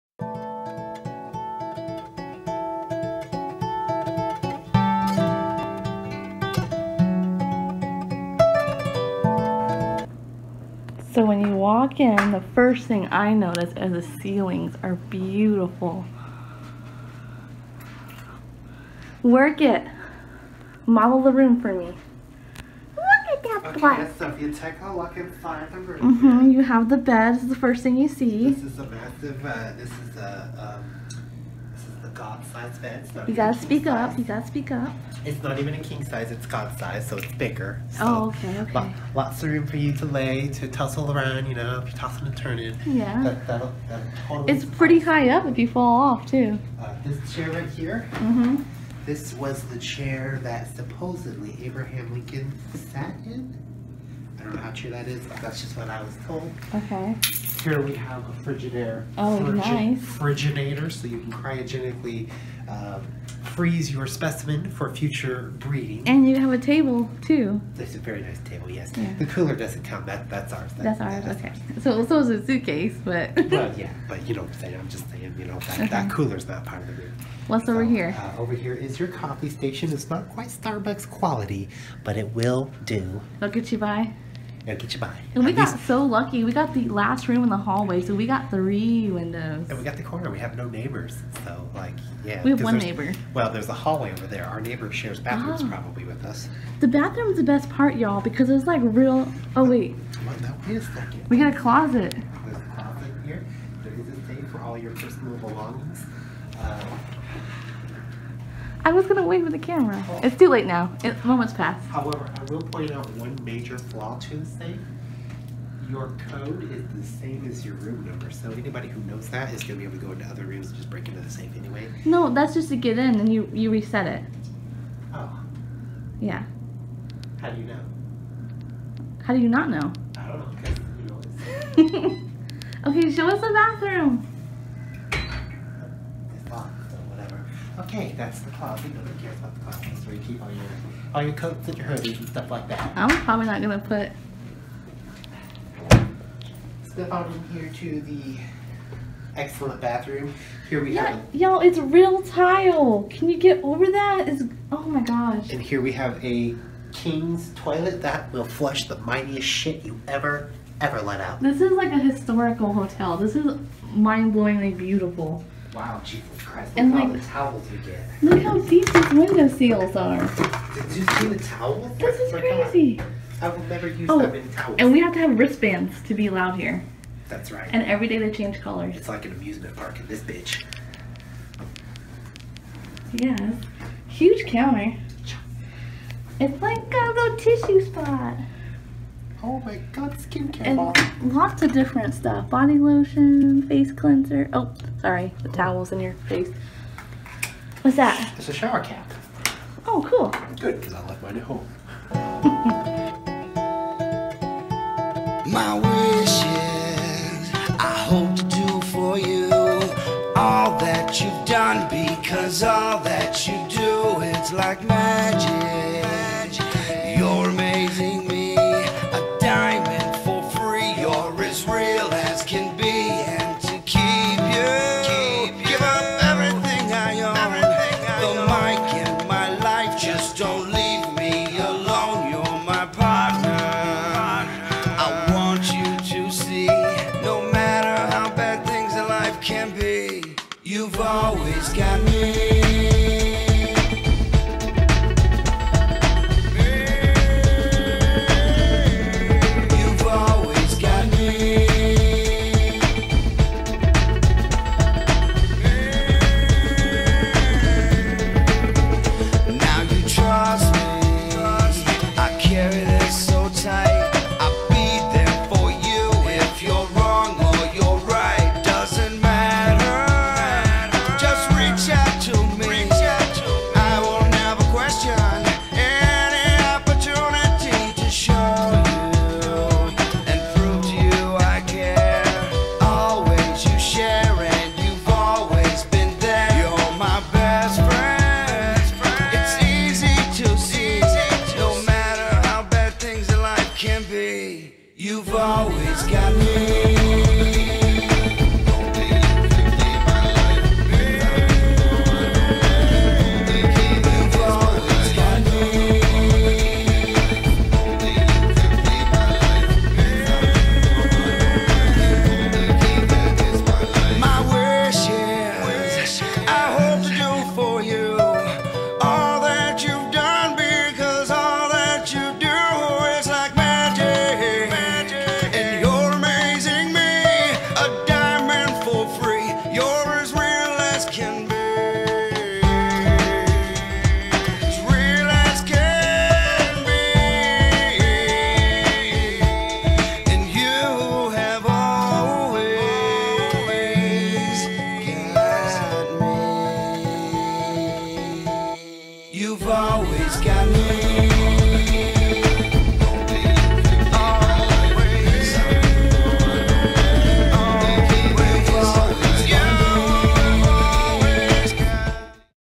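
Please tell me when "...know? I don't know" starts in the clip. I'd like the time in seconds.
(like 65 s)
129 s.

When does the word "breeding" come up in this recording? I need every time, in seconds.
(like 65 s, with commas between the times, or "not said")
65 s.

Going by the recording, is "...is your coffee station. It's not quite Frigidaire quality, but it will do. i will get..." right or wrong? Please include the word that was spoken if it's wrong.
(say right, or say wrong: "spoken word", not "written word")
wrong: "Starbucks", not "Frigidaire".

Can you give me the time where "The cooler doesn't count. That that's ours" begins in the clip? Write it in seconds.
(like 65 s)
69 s.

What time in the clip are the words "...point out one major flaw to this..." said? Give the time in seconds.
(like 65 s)
112 s.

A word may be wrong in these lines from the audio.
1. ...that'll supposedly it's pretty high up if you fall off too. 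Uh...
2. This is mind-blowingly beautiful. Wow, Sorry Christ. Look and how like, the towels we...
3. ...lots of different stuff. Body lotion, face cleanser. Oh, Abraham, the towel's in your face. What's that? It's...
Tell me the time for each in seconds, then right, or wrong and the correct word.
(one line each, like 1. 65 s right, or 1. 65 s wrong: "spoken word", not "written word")
1. 43 s wrong: "totally", not "supposedly"
2. 163 s wrong: "Jesus", not "Sorry"
3. 191 s wrong: "Sorry", not "Abraham".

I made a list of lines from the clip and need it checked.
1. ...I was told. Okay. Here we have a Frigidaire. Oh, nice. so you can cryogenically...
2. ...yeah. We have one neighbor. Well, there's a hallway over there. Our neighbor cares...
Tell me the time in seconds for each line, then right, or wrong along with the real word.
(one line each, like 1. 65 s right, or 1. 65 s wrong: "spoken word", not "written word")
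1. 55 s right
2. 92 s wrong: "shares", not "cares".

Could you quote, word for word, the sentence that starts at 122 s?
No, that's just to get in and you you reset it.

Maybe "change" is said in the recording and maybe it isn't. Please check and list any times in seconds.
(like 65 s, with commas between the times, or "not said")
178 s.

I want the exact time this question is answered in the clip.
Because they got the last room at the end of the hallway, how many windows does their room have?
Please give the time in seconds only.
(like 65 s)
88 s.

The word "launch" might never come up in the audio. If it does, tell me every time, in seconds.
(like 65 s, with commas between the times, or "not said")
not said.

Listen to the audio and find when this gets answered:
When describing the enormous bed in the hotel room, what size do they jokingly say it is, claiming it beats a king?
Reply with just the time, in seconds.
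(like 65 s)
32 s.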